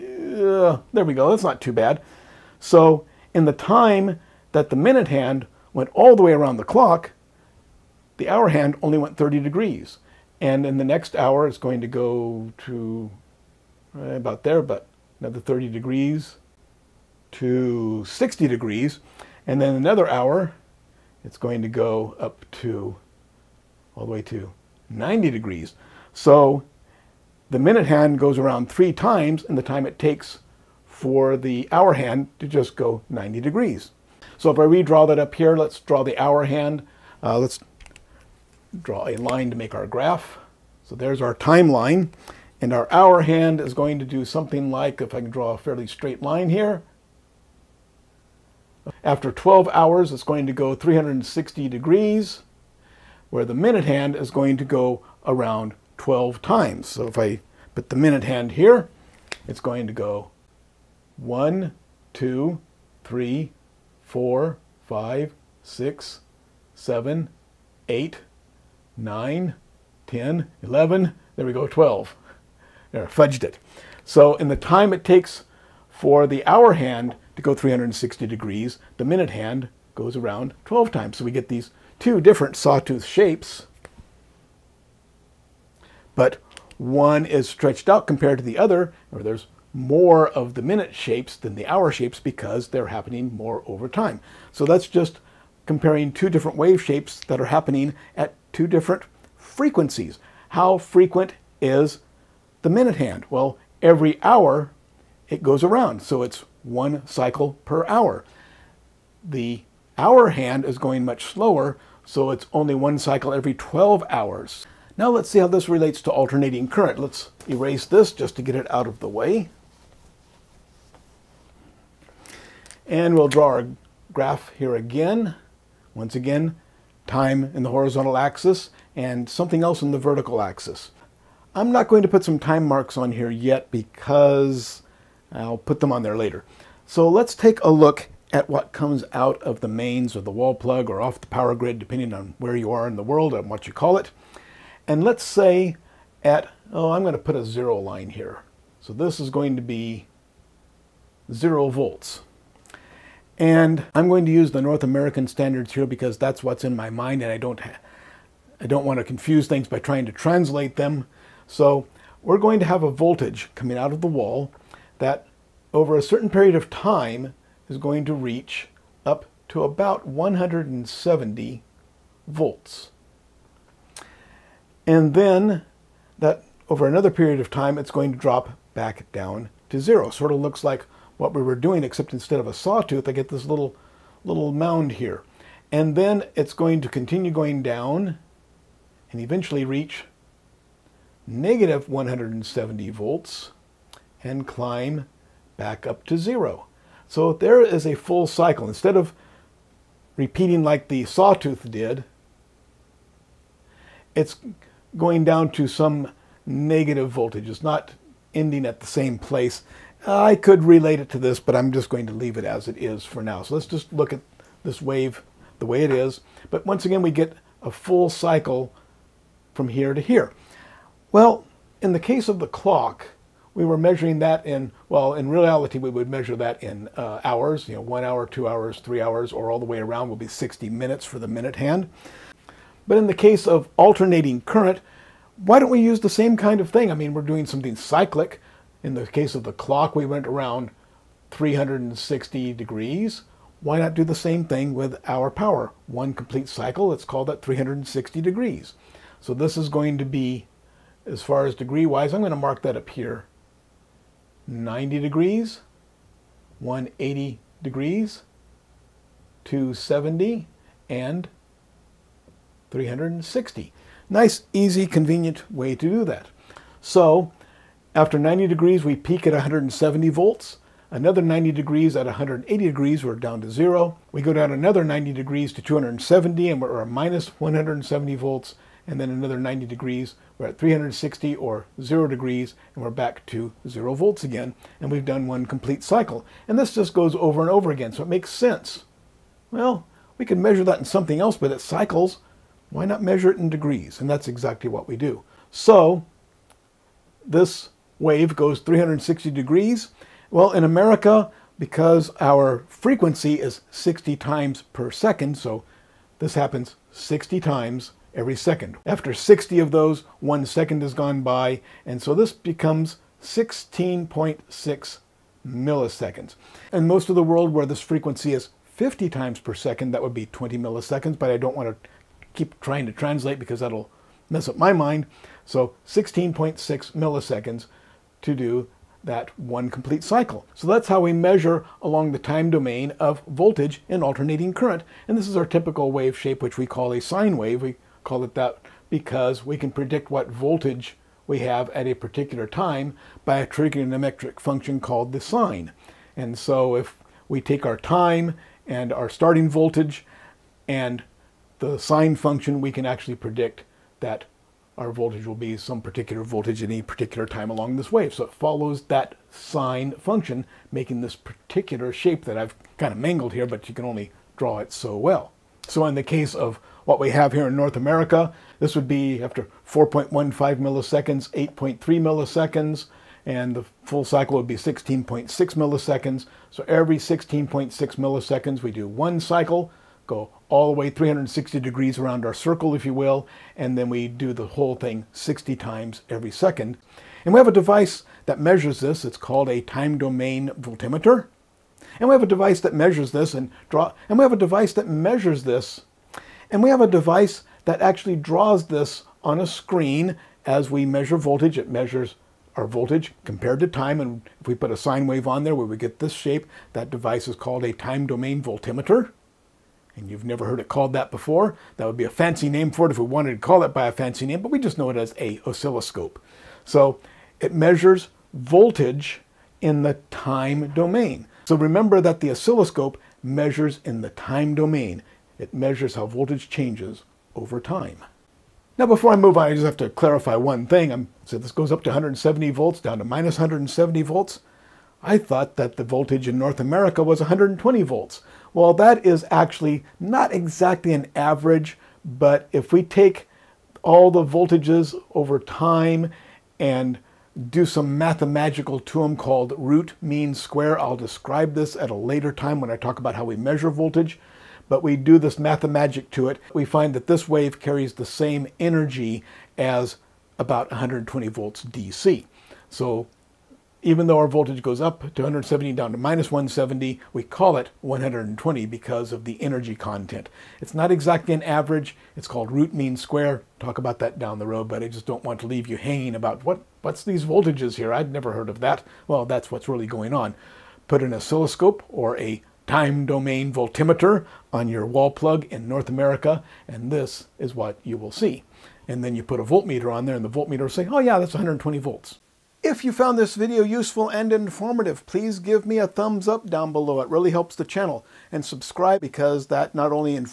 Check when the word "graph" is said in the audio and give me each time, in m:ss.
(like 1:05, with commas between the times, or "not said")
0:39, 2:04.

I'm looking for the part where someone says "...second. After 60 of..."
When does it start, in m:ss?
5:08.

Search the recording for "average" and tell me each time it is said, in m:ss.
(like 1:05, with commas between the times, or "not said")
7:21, 7:51.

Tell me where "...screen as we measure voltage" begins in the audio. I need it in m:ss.
6:39.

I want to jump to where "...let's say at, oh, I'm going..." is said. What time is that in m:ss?
2:25.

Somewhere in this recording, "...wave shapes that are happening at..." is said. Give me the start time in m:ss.
1:36.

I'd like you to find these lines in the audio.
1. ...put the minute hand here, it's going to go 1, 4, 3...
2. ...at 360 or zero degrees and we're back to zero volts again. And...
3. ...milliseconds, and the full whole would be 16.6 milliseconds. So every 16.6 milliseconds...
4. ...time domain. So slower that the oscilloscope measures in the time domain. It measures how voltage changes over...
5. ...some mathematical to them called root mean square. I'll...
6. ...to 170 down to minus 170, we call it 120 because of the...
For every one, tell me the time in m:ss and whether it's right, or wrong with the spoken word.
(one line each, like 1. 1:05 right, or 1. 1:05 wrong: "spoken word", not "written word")
1. 0:57 wrong: "2", not "4"
2. 4:40 right
3. 6:11 wrong: "cycle", not "whole"
4. 7:00 wrong: "remember", not "slower"
5. 7:27 right
6. 7:45 right.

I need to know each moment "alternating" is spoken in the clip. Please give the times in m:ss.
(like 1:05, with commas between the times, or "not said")
1:56, 3:53, 5:34.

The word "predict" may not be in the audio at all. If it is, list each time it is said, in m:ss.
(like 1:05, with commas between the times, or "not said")
5:39, 5:53.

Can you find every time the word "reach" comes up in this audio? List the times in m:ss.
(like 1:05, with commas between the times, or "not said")
2:48, 3:09.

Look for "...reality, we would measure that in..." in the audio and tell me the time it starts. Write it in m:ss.
3:45.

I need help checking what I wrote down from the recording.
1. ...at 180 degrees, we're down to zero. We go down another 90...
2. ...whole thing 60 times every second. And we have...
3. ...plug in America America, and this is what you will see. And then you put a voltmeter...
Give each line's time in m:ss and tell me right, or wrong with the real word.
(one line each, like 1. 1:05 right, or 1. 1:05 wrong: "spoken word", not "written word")
1. 4:31 right
2. 6:24 right
3. 8:05 wrong: "North", not "America".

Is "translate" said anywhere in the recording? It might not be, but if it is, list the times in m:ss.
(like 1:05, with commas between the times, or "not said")
2:40, 5:22.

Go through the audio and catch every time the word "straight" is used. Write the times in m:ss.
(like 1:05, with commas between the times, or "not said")
0:45.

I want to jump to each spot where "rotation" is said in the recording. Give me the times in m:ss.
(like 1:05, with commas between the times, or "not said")
not said.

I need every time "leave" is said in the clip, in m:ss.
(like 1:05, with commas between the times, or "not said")
3:32, 7:55.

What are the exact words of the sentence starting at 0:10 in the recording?
And in the next hour, it's going to go to eh, about there, but another 30 degrees to 60 degrees.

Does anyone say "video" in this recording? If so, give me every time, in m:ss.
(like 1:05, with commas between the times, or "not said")
8:13.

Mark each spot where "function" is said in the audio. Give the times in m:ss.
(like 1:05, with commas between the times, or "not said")
5:44, 5:52, 5:59.